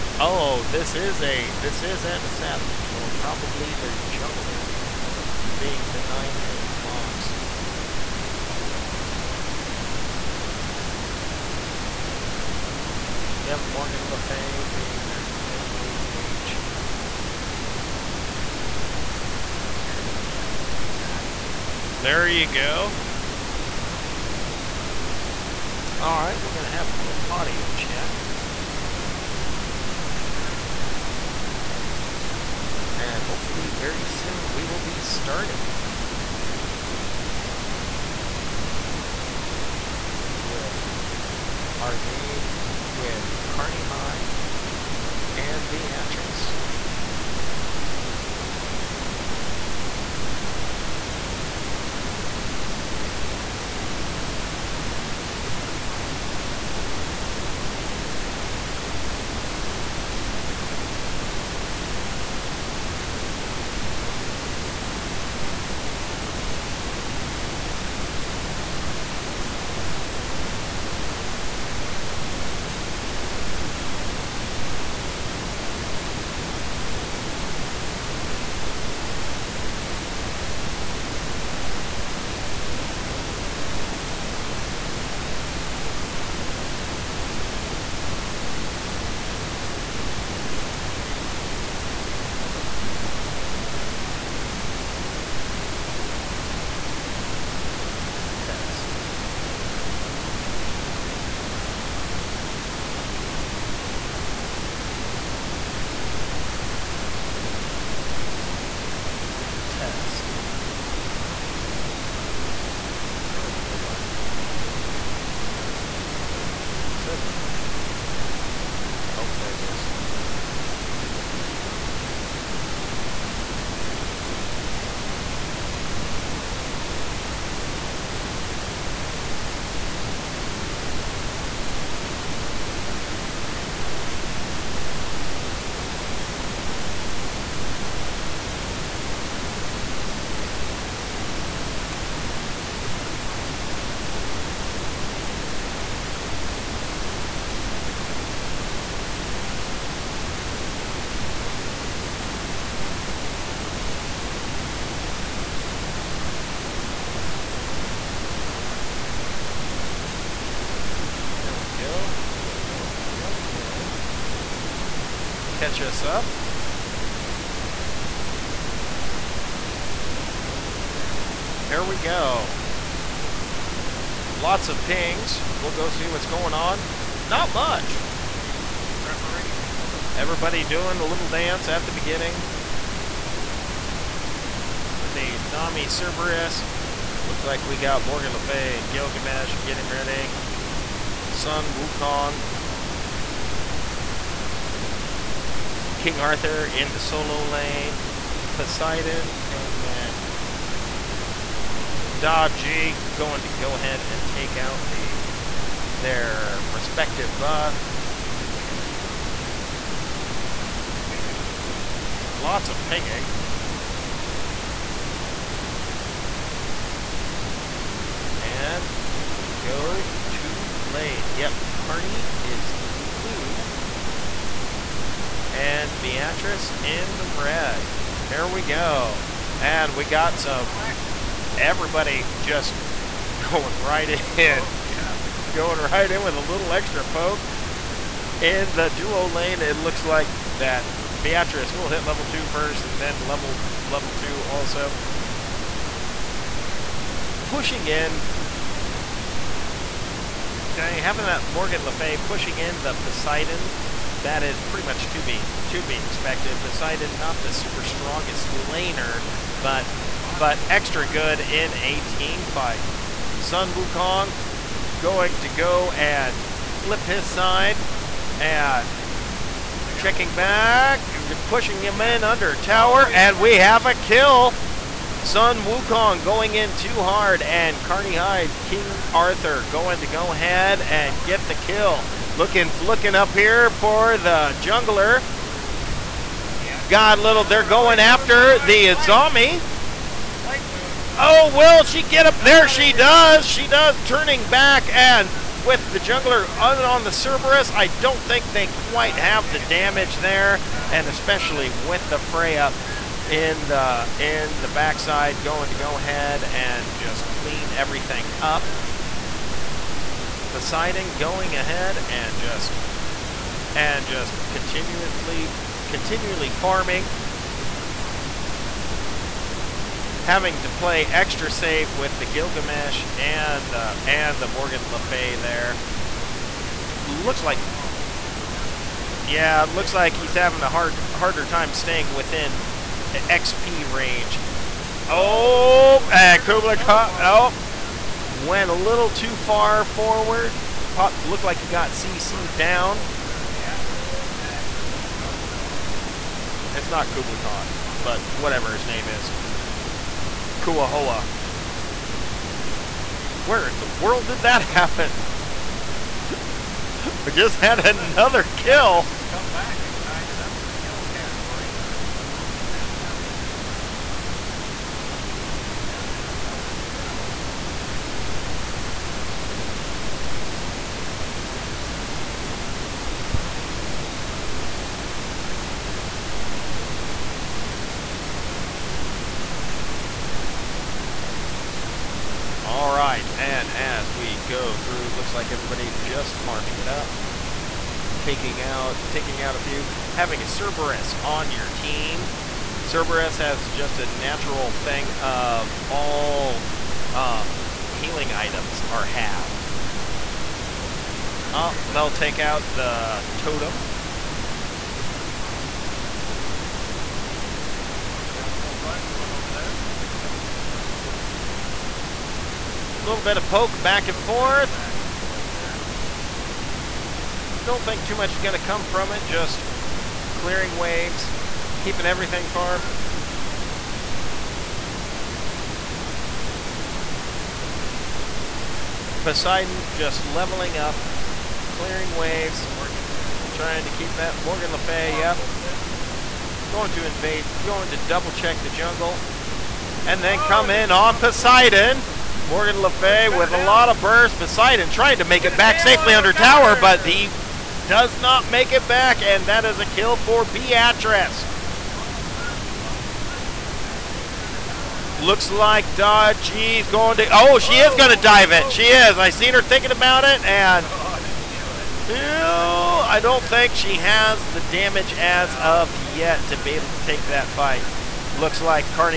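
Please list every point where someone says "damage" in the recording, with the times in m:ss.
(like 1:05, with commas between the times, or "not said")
4:59, 7:44.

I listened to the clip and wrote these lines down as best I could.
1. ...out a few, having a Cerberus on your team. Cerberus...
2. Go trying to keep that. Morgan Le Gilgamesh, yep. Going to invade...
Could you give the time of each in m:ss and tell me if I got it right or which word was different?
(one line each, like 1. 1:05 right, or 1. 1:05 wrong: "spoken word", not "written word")
1. 6:29 right
2. 7:12 wrong: "Fay", not "Gilgamesh".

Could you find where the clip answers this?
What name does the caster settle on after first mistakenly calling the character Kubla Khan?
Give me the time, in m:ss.
5:50.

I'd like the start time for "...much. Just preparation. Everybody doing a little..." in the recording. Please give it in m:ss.
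2:57.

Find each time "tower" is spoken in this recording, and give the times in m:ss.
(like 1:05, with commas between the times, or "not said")
4:32, 7:26.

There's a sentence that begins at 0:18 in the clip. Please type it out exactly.
Got some people cheering for Beatrice in the chat.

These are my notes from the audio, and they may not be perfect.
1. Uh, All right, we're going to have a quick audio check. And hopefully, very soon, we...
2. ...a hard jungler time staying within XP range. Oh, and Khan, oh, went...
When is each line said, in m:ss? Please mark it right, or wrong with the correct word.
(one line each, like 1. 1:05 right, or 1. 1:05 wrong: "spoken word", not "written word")
1. 0:25 right
2. 5:30 wrong: "harder", not "jungler".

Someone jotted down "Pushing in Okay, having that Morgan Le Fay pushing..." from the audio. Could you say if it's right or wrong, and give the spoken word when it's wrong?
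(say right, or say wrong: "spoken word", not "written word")
right.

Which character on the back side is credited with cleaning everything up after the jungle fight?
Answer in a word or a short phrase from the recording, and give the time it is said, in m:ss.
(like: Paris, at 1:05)
Freya, at 5:02.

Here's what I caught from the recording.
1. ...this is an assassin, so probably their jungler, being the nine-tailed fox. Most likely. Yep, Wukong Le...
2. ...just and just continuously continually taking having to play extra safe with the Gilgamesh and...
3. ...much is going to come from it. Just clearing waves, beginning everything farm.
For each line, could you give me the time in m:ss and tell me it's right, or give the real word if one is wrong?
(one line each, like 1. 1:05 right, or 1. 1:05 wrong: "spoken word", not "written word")
1. 0:01 wrong: "Morgan", not "Wukong"
2. 5:12 wrong: "farming", not "taking"
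3. 6:58 wrong: "keeping", not "beginning".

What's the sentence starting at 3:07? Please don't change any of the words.
Looks like we got Morgan Le Fay and Gilgamesh getting ready.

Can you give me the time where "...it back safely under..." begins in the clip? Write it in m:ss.
7:25.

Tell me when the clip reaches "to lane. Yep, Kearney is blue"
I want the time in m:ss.
3:40.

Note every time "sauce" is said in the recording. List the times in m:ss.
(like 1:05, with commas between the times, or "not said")
not said.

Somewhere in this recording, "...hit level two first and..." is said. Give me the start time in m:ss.
4:01.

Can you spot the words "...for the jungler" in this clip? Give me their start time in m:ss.
4:43.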